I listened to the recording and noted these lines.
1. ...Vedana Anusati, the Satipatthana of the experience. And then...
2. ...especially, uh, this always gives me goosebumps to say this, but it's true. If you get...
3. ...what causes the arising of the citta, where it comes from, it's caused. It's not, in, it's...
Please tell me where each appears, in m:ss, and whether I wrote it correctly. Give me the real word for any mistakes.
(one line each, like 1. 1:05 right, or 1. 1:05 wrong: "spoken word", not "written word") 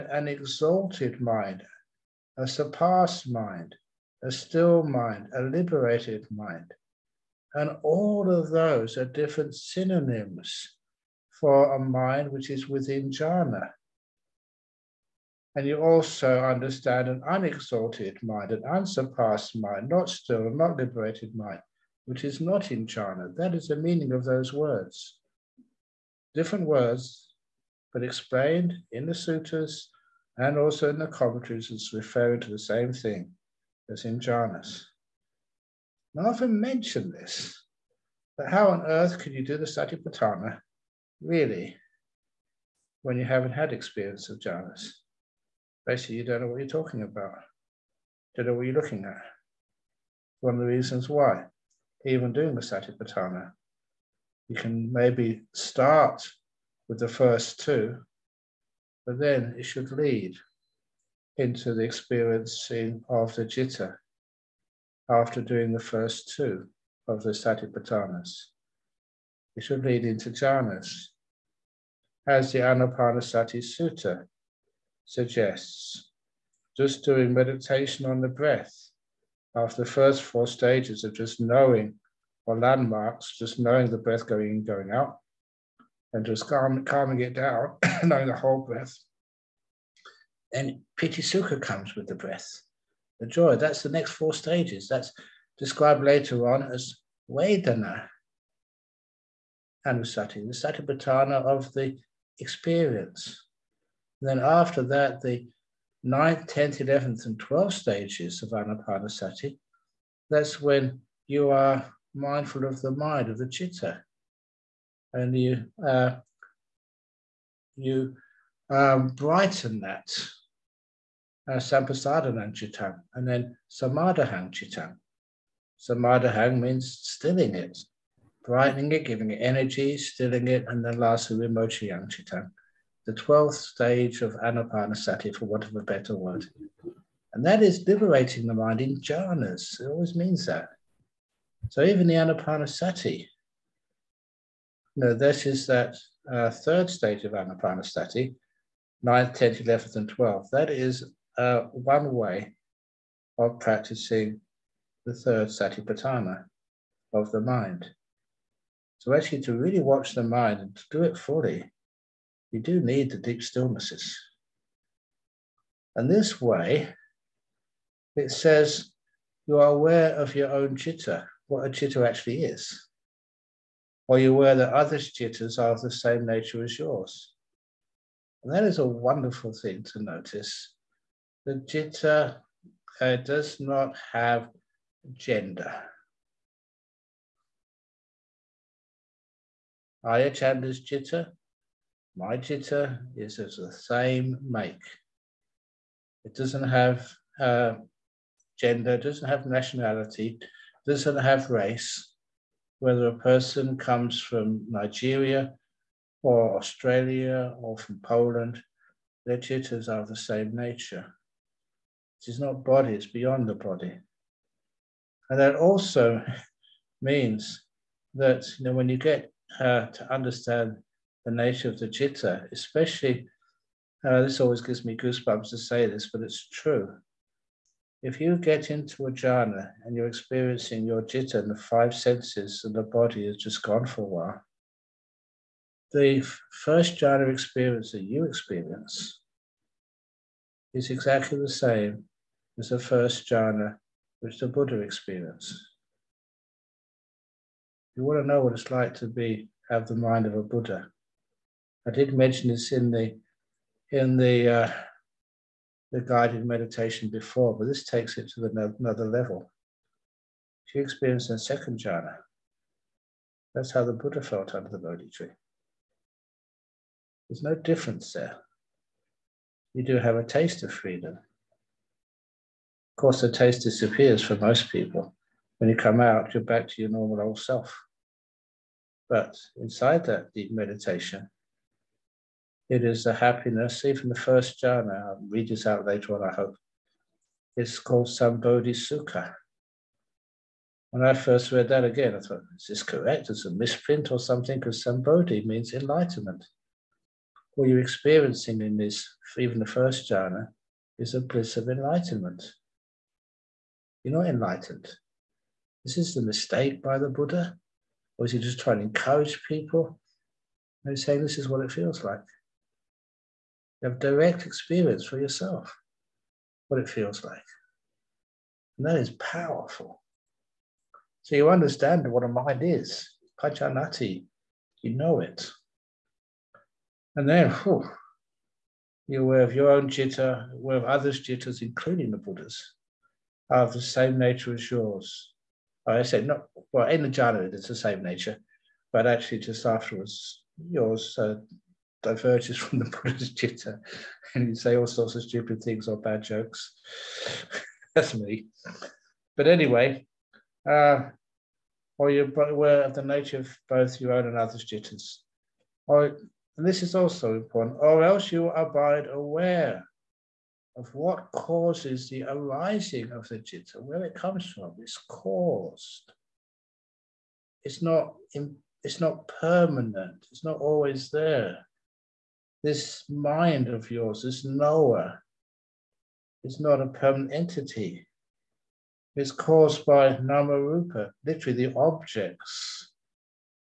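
1. 1:37 right
2. 3:42 right
3. 6:00 right.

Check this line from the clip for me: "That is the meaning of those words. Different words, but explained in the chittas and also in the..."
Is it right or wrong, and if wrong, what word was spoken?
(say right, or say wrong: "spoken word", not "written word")
wrong: "sutras", not "chittas".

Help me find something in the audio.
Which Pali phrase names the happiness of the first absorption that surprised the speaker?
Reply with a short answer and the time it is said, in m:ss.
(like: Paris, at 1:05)
Sambodhi Sukha, at 4:48.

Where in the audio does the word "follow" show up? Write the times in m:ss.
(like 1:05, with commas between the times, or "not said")
not said.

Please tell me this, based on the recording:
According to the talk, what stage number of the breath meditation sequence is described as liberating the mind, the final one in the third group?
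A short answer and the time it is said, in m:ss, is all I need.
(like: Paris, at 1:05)
12th, at 2:13.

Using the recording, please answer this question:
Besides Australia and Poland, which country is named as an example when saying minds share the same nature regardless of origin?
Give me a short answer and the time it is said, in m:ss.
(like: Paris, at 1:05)
Nigeria, at 3:24.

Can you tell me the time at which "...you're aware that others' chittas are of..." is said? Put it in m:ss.
2:54.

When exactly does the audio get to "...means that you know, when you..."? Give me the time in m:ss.
3:37.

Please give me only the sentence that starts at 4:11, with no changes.
I did mention this in the in the uh, the guided meditation before, but this takes it to the, another level.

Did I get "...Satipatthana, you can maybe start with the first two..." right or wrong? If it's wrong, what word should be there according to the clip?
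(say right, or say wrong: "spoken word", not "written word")
right.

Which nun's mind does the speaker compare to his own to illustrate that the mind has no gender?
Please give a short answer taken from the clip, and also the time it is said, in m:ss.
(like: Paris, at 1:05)
Ayya Candā, at 3:10.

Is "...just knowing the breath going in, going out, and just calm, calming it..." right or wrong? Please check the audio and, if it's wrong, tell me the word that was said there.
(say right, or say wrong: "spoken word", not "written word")
right.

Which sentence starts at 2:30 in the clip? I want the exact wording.
That is uh, one way of practicing the third satipatthana of the mind.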